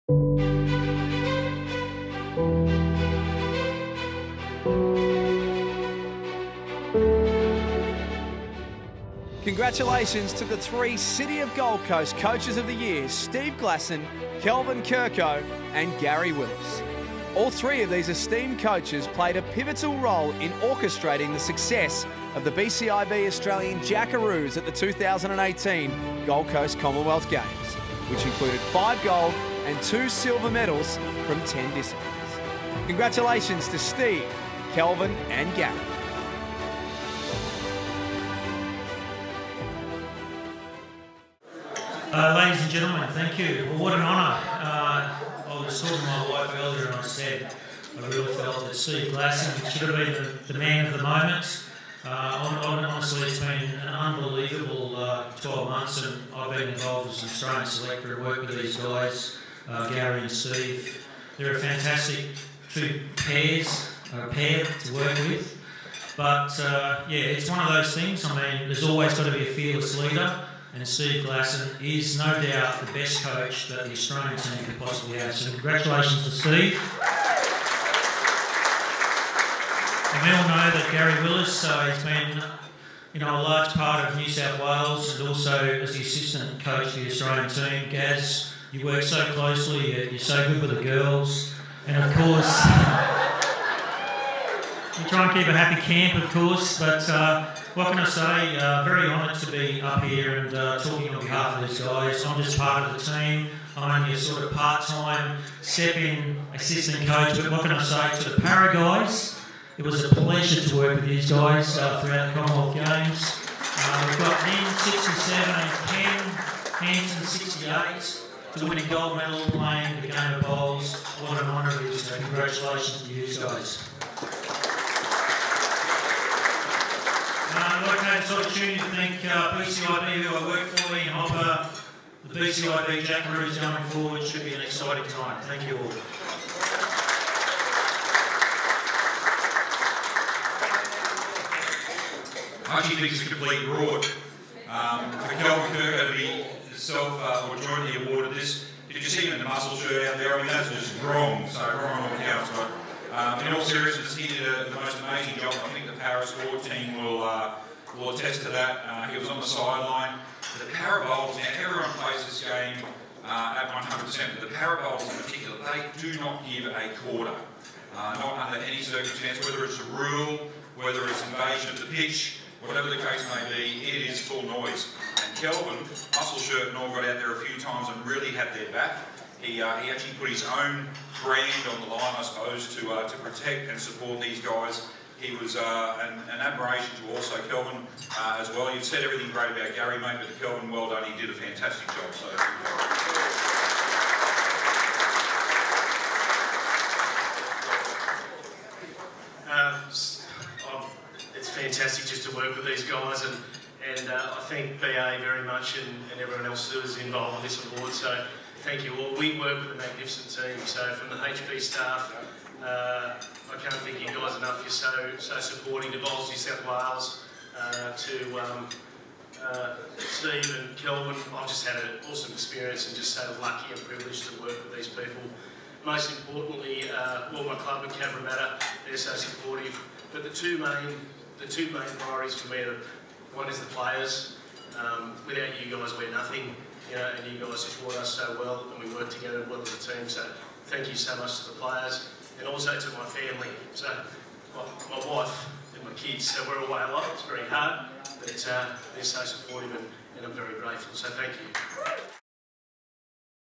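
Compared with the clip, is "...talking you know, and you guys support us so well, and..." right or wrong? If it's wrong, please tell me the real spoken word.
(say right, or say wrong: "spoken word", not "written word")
wrong: "nothing", not "talking".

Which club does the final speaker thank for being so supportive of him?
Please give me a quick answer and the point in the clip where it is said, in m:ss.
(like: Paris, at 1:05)
Cabramatta, at 3:47.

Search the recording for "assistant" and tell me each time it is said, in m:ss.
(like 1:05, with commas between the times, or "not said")
1:26, 1:46.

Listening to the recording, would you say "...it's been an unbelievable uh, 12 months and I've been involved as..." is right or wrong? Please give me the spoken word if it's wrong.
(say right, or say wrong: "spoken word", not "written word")
right.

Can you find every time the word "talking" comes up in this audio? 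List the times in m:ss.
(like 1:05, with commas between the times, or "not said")
0:45, 1:40.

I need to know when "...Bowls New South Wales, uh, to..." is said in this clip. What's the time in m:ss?
3:35.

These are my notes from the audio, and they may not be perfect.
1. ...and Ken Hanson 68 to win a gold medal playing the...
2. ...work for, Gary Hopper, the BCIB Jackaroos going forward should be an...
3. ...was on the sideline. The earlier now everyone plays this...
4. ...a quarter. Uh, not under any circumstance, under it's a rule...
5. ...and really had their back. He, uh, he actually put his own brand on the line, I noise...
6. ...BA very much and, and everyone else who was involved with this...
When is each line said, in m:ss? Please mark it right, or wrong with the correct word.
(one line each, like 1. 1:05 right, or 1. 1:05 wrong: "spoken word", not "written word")
1. 1:55 right
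2. 2:10 wrong: "Ian", not "Gary"
3. 2:39 wrong: "power", not "earlier"
4. 2:46 wrong: "whether", not "under"
5. 2:57 wrong: "suppose", not "noise"
6. 3:24 right.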